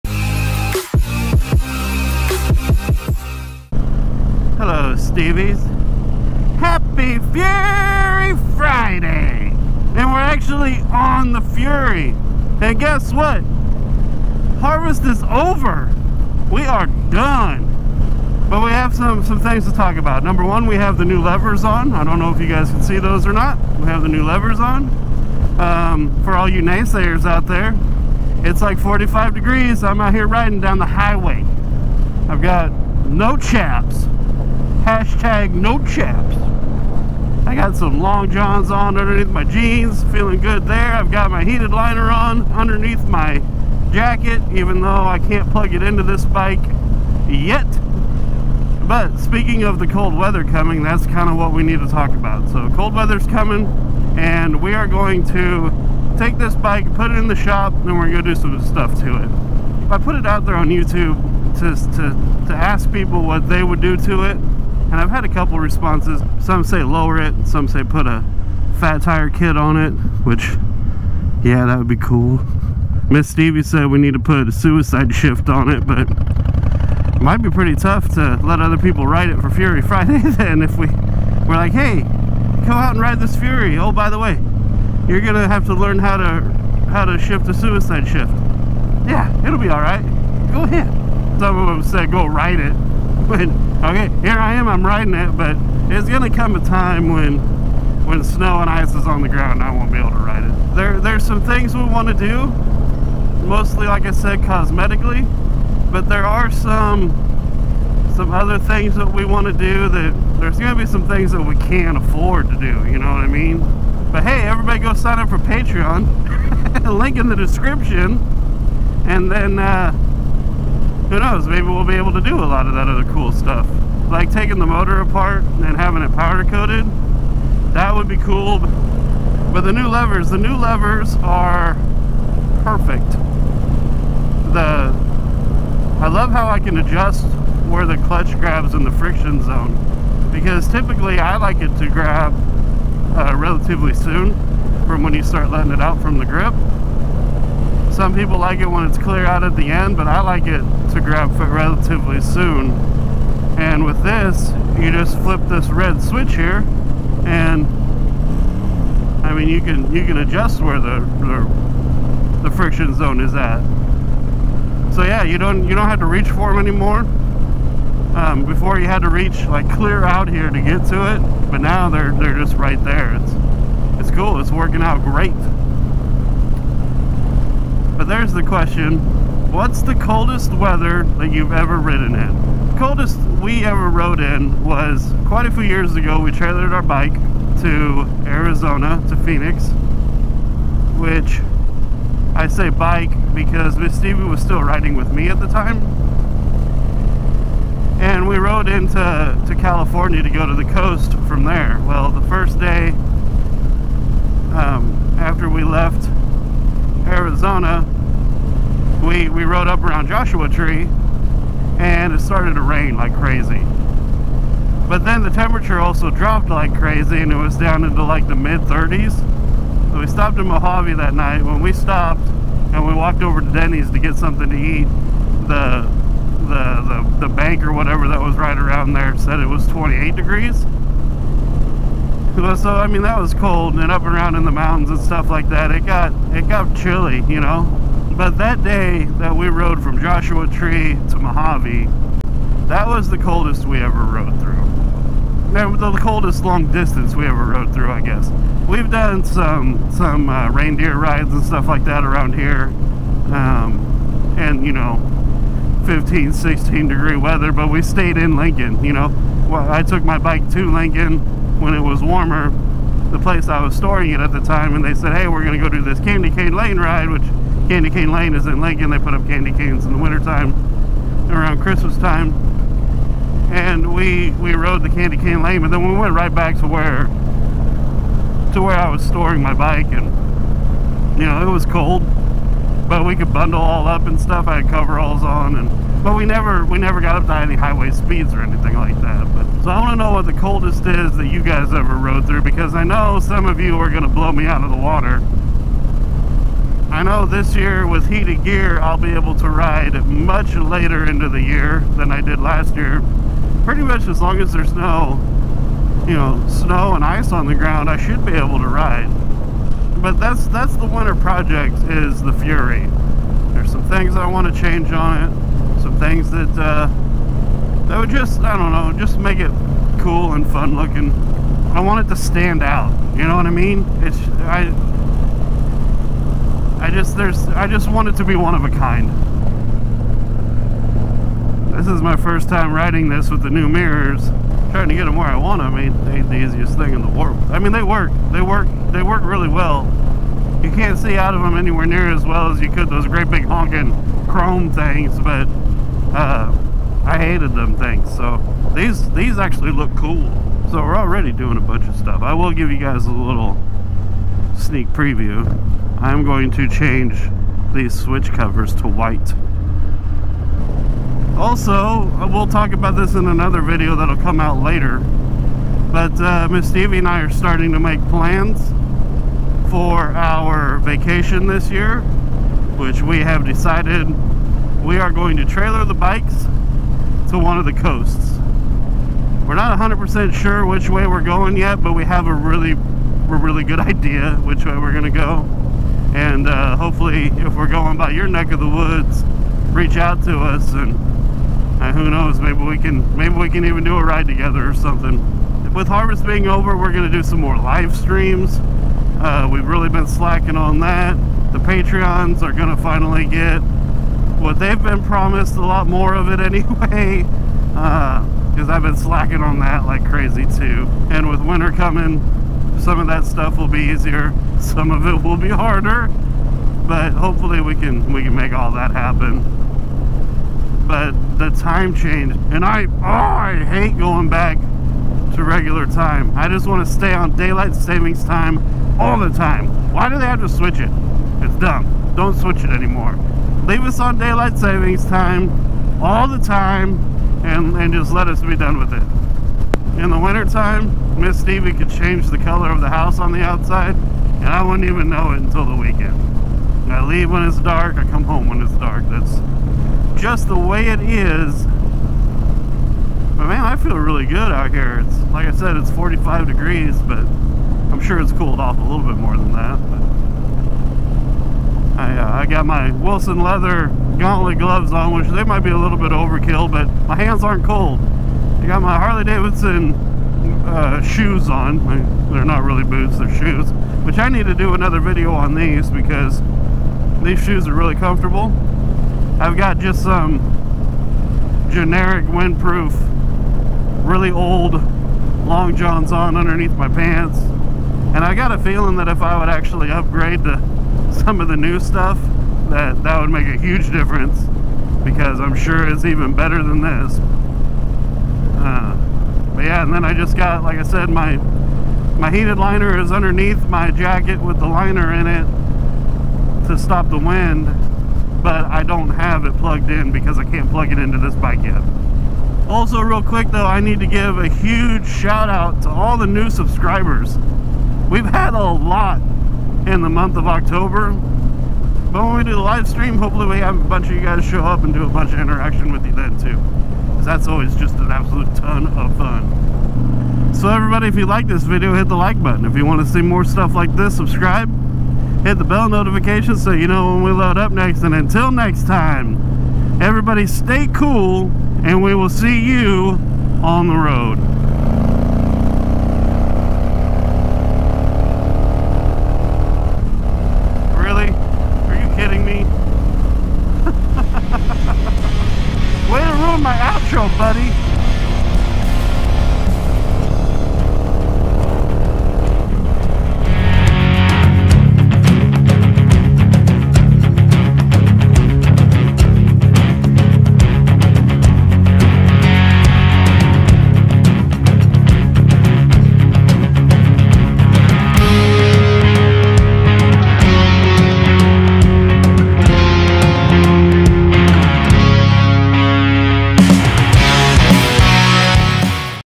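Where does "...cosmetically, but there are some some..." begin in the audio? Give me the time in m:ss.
1:44.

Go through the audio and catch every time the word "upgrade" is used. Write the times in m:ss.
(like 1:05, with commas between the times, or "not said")
8:09.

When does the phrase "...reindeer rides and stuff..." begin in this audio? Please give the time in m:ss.
4:10.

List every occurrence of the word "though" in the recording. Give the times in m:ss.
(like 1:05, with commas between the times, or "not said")
0:44, 8:33.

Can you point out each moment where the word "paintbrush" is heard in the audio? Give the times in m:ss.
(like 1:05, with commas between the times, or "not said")
not said.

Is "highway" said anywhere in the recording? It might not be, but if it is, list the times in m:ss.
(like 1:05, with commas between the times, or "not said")
0:30, 4:47.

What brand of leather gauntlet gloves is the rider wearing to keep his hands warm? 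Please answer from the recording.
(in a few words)
Wilson.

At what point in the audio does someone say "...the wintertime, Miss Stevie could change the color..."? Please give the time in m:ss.
7:20.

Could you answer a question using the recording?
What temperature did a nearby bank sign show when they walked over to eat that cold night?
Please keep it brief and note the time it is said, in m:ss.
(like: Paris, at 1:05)
28 degrees, at 3:49.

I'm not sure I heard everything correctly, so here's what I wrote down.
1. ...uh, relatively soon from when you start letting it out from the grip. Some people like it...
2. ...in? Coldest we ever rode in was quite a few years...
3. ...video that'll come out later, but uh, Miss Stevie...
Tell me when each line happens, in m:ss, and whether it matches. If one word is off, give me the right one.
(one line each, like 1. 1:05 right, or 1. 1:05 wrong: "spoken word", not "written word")
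1. 2:23 right
2. 3:02 right
3. 6:03 right.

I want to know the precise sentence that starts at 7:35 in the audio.
It's like I said, it's 45 degrees, but I'm sure it's cooled off a little bit more than that.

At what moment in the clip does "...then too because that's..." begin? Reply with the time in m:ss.
8:46.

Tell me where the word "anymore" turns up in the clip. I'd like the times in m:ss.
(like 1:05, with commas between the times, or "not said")
2:46, 7:12.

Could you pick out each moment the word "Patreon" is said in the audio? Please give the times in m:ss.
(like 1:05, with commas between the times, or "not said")
1:55, 6:41.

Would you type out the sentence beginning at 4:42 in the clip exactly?
But we could bundle all up and stuff.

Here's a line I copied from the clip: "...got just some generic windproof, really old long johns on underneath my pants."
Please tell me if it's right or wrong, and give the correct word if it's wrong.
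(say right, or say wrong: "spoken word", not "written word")
right.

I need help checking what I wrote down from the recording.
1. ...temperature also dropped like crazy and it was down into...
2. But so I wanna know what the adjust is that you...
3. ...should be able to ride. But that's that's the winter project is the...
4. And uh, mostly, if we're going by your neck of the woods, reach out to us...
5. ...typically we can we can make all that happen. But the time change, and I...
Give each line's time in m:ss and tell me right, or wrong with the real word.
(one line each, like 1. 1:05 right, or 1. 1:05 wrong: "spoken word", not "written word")
1. 3:35 right
2. 4:49 wrong: "coldest", not "adjust"
3. 5:07 right
4. 6:26 wrong: "hopefully", not "mostly"
5. 6:57 wrong: "hopefully", not "typically".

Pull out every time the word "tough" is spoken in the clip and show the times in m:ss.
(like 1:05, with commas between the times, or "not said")
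1:17.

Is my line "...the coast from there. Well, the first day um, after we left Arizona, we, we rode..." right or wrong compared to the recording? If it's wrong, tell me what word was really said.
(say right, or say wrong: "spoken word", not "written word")
right.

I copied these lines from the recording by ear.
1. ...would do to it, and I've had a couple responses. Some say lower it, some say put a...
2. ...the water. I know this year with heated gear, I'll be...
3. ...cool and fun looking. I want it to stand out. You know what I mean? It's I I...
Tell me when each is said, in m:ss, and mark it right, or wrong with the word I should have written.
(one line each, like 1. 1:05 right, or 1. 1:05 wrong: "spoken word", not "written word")
1. 1:03 right
2. 4:54 right
3. 5:20 right.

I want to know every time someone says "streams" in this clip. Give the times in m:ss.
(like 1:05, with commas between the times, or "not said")
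6:37, 8:42.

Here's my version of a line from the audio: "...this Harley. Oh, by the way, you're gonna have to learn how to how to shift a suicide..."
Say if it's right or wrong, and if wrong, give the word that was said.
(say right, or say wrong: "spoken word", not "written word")
wrong: "Fury", not "Harley".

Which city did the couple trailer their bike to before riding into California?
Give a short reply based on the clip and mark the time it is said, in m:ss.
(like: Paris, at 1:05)
Phoenix, at 3:09.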